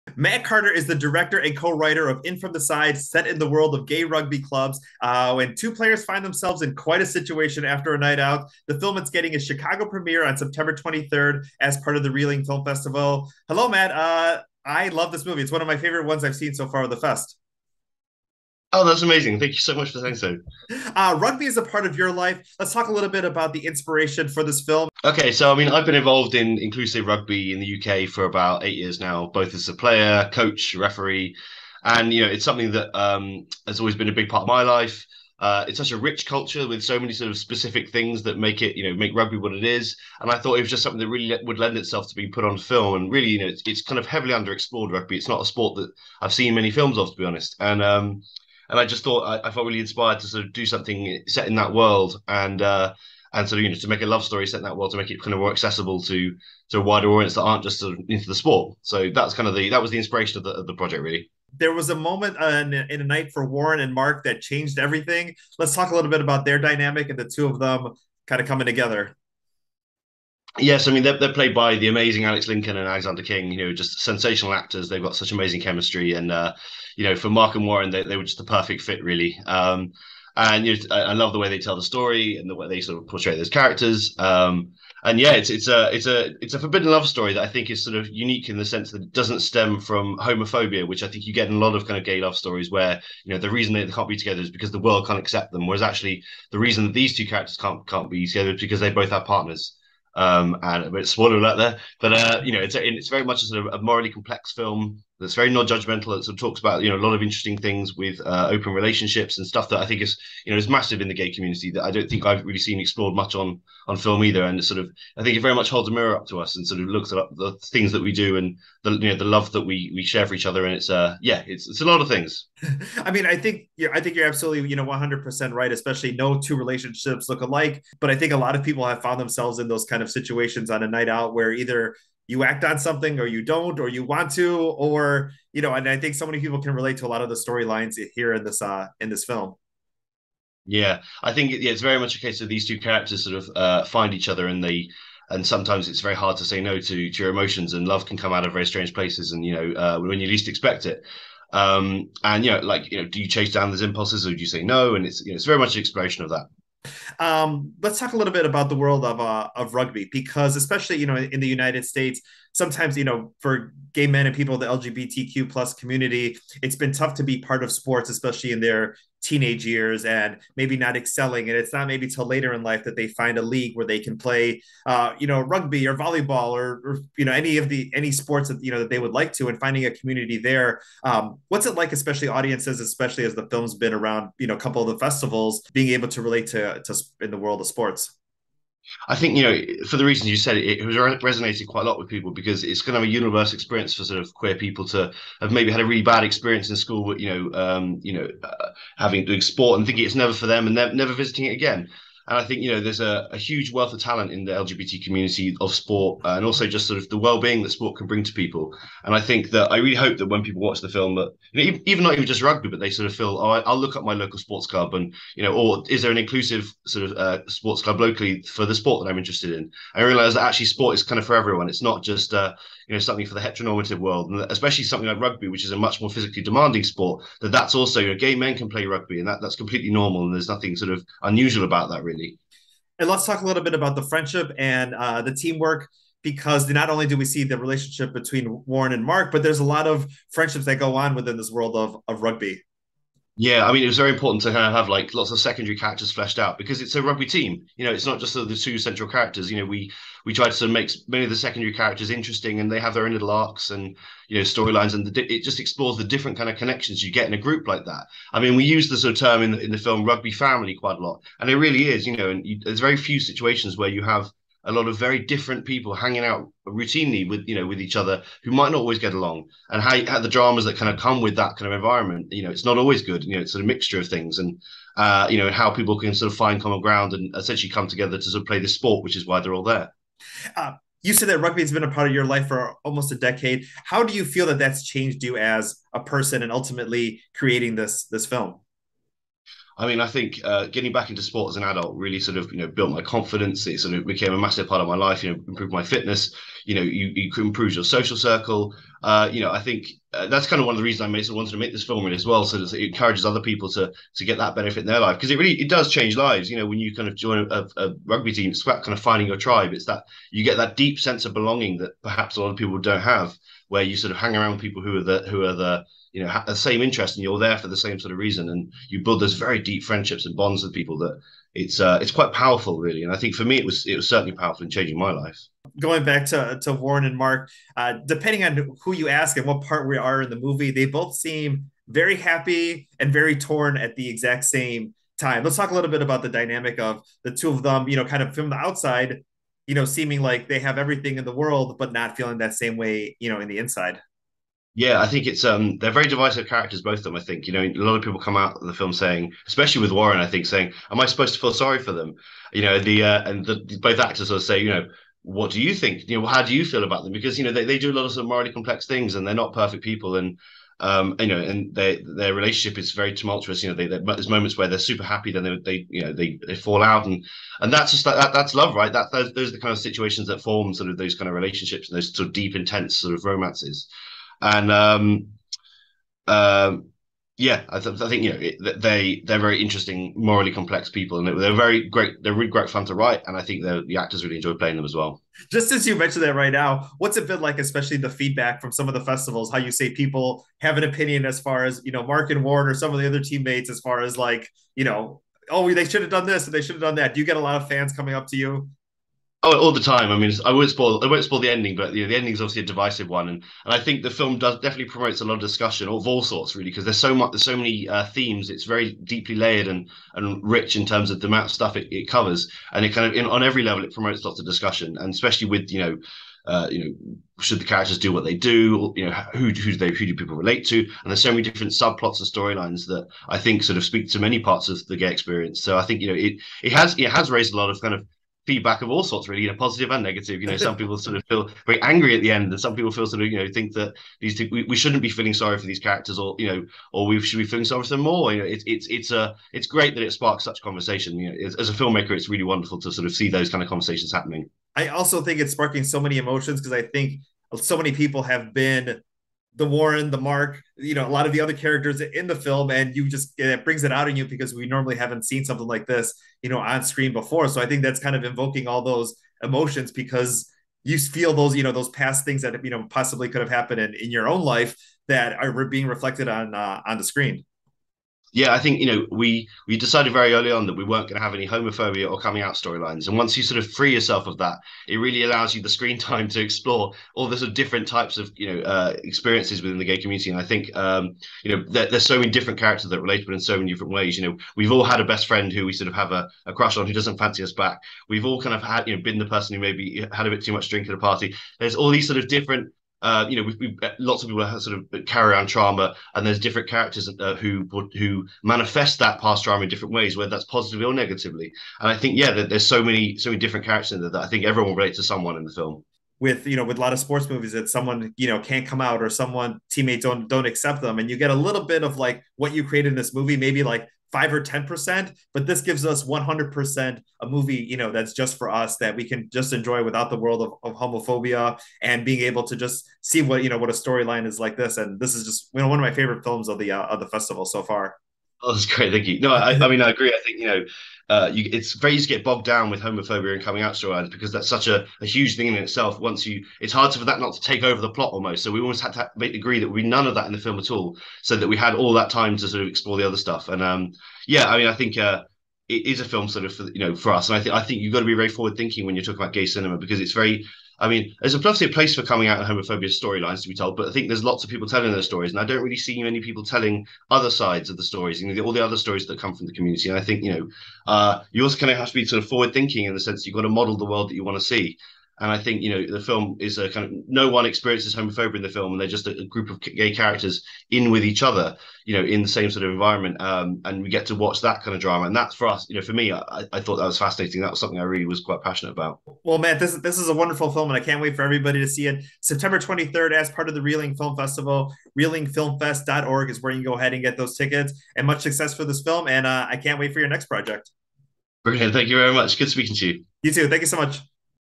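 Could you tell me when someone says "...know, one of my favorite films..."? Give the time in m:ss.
8:45.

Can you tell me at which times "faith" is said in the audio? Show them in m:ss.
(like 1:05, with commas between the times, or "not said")
not said.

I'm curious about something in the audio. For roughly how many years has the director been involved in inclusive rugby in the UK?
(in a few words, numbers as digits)
8.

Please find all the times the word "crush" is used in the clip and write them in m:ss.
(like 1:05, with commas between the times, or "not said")
8:06.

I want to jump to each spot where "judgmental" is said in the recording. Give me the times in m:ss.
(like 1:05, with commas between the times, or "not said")
1:45.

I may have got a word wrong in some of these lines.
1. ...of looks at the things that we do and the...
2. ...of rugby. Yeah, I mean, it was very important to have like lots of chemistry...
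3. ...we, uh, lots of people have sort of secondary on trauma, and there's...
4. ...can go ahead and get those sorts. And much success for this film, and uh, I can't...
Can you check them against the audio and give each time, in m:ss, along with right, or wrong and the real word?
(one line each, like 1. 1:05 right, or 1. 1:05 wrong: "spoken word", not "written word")
1. 1:56 right
2. 4:02 wrong: "secondary", not "chemistry"
3. 8:13 wrong: "carry", not "secondary"
4. 9:46 wrong: "tickets", not "sorts".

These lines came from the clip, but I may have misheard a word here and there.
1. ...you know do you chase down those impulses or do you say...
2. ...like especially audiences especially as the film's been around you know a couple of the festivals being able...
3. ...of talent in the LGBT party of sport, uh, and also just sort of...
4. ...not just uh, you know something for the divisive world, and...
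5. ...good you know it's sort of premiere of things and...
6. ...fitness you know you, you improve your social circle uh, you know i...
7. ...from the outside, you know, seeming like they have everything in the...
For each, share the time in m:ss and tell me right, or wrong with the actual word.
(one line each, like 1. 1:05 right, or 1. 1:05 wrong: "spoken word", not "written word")
1. 2:32 right
2. 3:01 right
3. 3:23 wrong: "community", not "party"
4. 3:41 wrong: "heteronormative", not "divisive"
5. 4:33 wrong: "mixture", not "premiere"
6. 4:55 right
7. 5:38 right.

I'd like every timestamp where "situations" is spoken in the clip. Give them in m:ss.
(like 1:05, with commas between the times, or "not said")
0:07, 2:10, 4:23, 6:09.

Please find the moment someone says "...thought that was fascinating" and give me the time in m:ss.
9:36.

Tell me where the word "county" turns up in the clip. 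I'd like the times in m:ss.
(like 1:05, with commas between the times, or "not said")
not said.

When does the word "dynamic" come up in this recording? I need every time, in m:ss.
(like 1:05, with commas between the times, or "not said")
1:06, 5:36.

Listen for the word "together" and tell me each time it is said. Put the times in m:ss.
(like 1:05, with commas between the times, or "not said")
1:08, 1:34, 1:38, 4:37.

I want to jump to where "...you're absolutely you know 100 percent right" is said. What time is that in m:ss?
2:04.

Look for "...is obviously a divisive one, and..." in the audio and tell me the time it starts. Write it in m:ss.
6:42.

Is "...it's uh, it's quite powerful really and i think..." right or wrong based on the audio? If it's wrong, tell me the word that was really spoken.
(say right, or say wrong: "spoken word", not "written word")
right.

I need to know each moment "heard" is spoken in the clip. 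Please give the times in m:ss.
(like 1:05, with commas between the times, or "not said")
not said.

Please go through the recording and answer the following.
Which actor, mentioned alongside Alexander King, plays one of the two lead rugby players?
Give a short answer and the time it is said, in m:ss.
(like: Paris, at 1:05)
Alex Lincoln, at 1:12.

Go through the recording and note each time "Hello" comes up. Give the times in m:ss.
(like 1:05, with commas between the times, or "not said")
0:13.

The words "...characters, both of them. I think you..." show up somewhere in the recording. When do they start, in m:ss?
5:46.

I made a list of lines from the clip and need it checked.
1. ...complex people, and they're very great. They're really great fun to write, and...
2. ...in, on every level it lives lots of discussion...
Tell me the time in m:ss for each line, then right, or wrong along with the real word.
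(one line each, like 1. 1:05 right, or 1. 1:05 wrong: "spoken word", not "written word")
1. 6:20 right
2. 6:53 wrong: "promotes", not "lives".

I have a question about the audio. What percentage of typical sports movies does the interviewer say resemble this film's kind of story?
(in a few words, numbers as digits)
5 or 10%.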